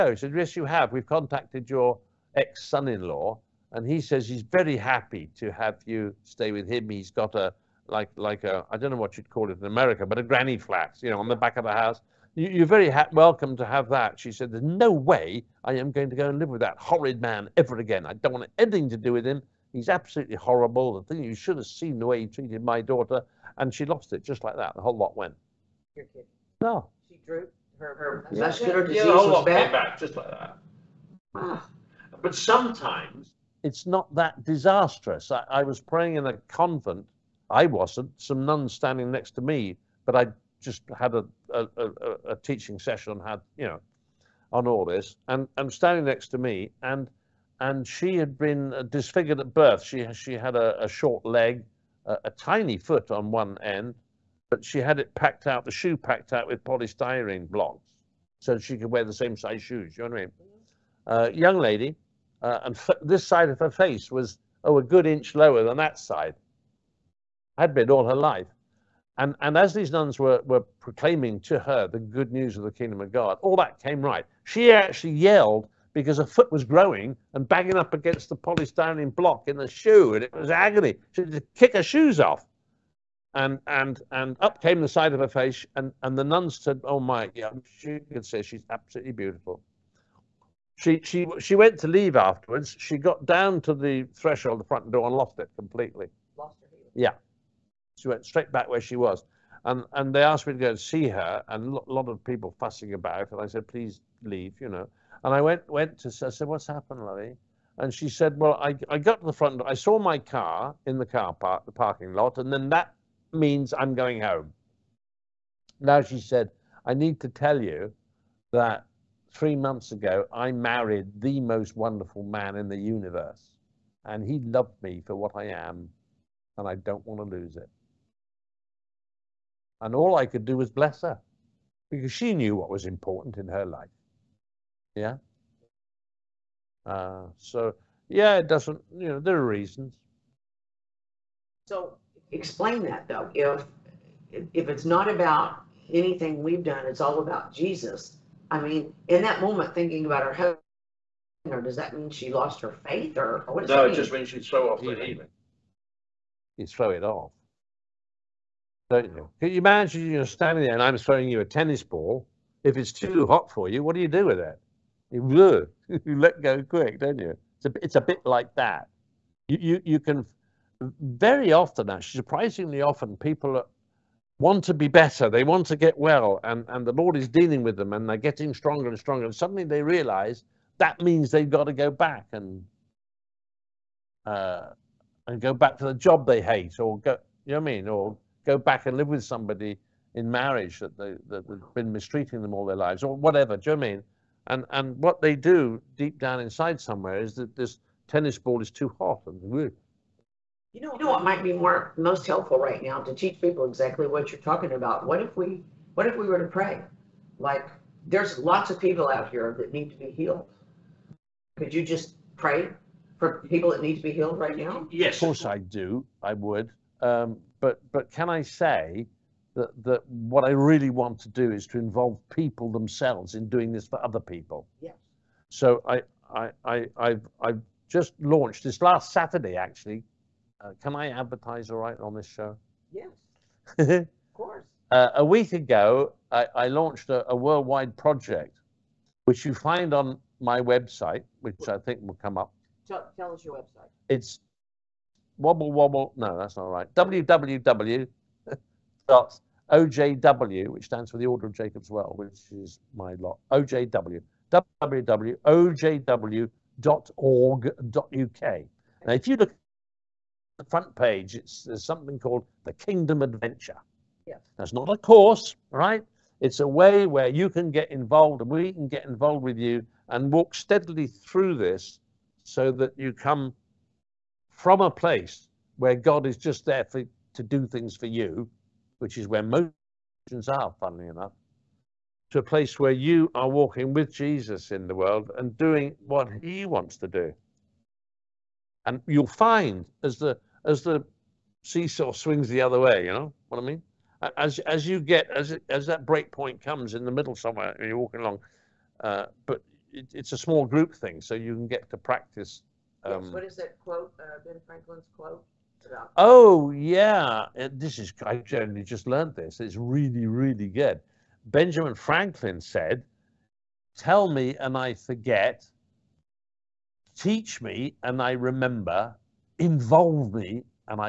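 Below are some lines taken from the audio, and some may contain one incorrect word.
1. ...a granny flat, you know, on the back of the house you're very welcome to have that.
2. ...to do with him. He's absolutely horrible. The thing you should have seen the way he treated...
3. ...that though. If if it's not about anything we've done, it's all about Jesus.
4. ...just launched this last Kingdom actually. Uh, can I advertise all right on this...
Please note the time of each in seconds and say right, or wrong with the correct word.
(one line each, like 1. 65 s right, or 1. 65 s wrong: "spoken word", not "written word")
1. 10 s right
2. 18 s right
3. 142 s right
4. 227 s wrong: "Saturday", not "Kingdom".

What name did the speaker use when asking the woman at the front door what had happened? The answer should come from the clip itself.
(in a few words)
Lorry.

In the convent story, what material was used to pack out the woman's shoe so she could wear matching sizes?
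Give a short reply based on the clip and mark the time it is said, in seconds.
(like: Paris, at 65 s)
Polystyrene blocks, at 56 s.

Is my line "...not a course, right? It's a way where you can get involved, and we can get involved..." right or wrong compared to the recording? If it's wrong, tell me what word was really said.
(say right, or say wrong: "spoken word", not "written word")
right.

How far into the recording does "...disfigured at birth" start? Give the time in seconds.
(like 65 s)
48 s.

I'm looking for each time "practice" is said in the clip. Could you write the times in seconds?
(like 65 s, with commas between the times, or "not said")
301 s.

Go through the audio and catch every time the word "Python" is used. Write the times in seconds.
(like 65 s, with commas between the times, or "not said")
not said.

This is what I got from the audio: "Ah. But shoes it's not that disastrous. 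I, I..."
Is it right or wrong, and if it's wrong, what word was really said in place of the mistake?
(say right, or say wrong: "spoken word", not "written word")
wrong: "sometimes", not "shoes".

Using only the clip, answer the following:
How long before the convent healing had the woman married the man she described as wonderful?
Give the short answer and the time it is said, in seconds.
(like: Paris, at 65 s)
Three months, at 119 s.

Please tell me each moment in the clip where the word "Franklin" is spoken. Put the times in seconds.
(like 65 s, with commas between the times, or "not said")
304 s, 311 s.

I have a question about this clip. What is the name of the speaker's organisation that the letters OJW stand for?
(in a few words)
Order of Jacob's Well.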